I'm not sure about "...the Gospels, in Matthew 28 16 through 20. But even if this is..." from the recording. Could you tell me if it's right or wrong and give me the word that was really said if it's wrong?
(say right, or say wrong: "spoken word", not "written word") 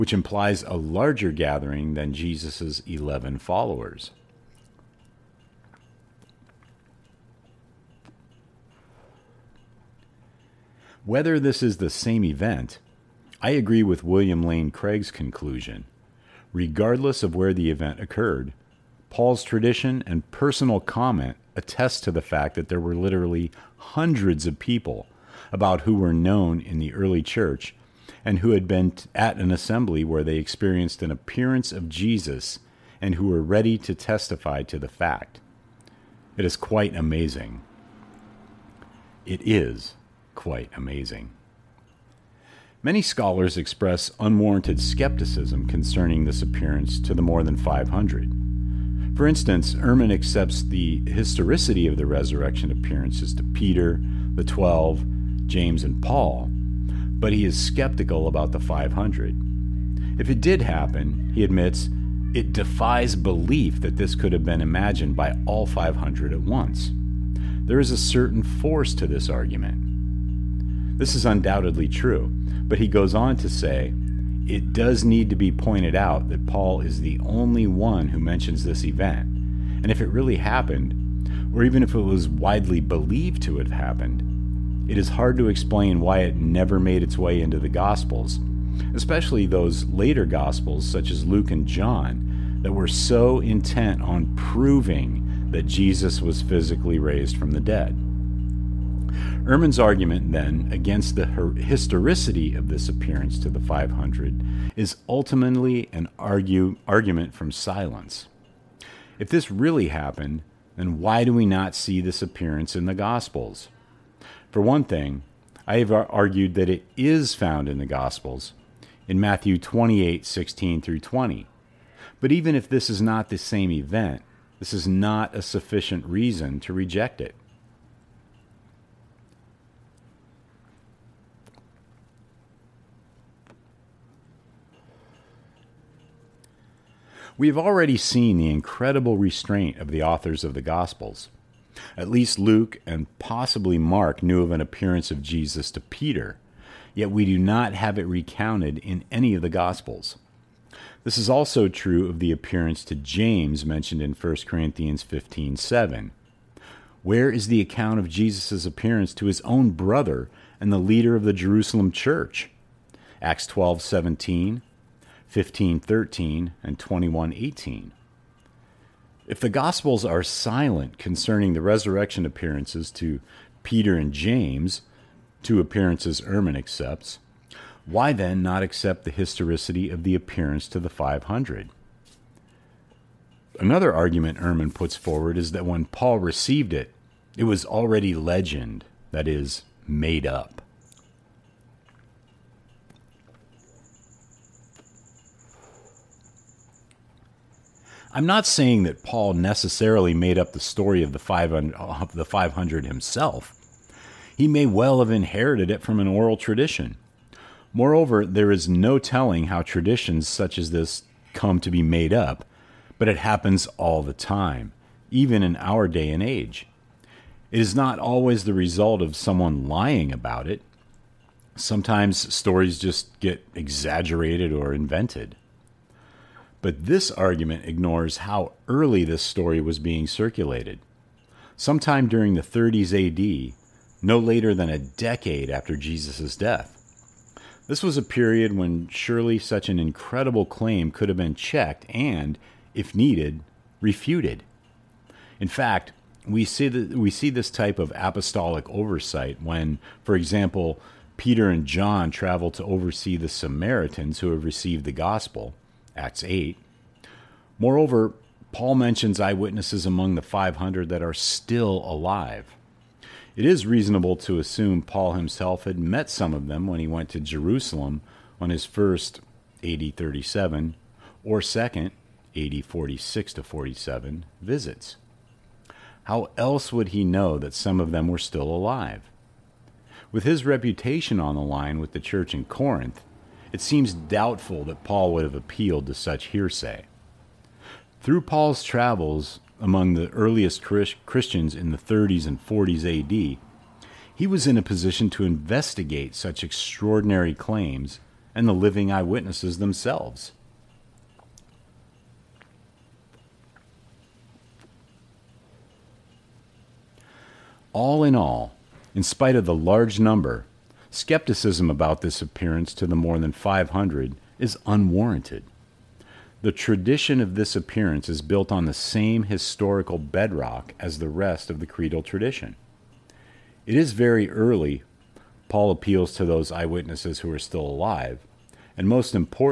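right.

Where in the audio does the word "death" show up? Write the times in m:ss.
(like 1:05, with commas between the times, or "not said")
3:56.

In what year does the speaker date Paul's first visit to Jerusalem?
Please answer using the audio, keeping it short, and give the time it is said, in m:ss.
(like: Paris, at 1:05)
AD 37, at 4:29.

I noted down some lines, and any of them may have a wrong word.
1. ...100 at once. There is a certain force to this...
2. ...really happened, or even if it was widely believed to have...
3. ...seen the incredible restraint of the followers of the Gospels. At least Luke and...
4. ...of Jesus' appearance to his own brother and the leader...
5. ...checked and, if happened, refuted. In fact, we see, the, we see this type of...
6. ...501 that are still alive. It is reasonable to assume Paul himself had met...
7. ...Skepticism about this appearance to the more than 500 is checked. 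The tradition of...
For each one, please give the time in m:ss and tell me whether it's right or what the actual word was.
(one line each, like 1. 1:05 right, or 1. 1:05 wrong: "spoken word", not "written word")
1. 1:05 wrong: "500", not "100"
2. 1:20 right
3. 2:17 wrong: "authors", not "followers"
4. 2:37 right
5. 4:01 wrong: "needed", not "happened"
6. 4:20 wrong: "500", not "501"
7. 5:10 wrong: "unwarranted", not "checked".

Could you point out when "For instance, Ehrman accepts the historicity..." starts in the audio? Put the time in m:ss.
0:49.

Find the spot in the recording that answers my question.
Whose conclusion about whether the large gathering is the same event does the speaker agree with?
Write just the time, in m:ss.
0:14.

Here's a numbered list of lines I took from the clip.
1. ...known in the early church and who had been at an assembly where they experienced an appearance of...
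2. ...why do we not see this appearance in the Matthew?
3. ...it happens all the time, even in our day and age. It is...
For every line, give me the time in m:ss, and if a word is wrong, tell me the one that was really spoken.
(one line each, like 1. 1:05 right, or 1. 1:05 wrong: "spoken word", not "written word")
1. 0:26 right
2. 1:51 wrong: "Gospels", not "Matthew"
3. 3:33 right.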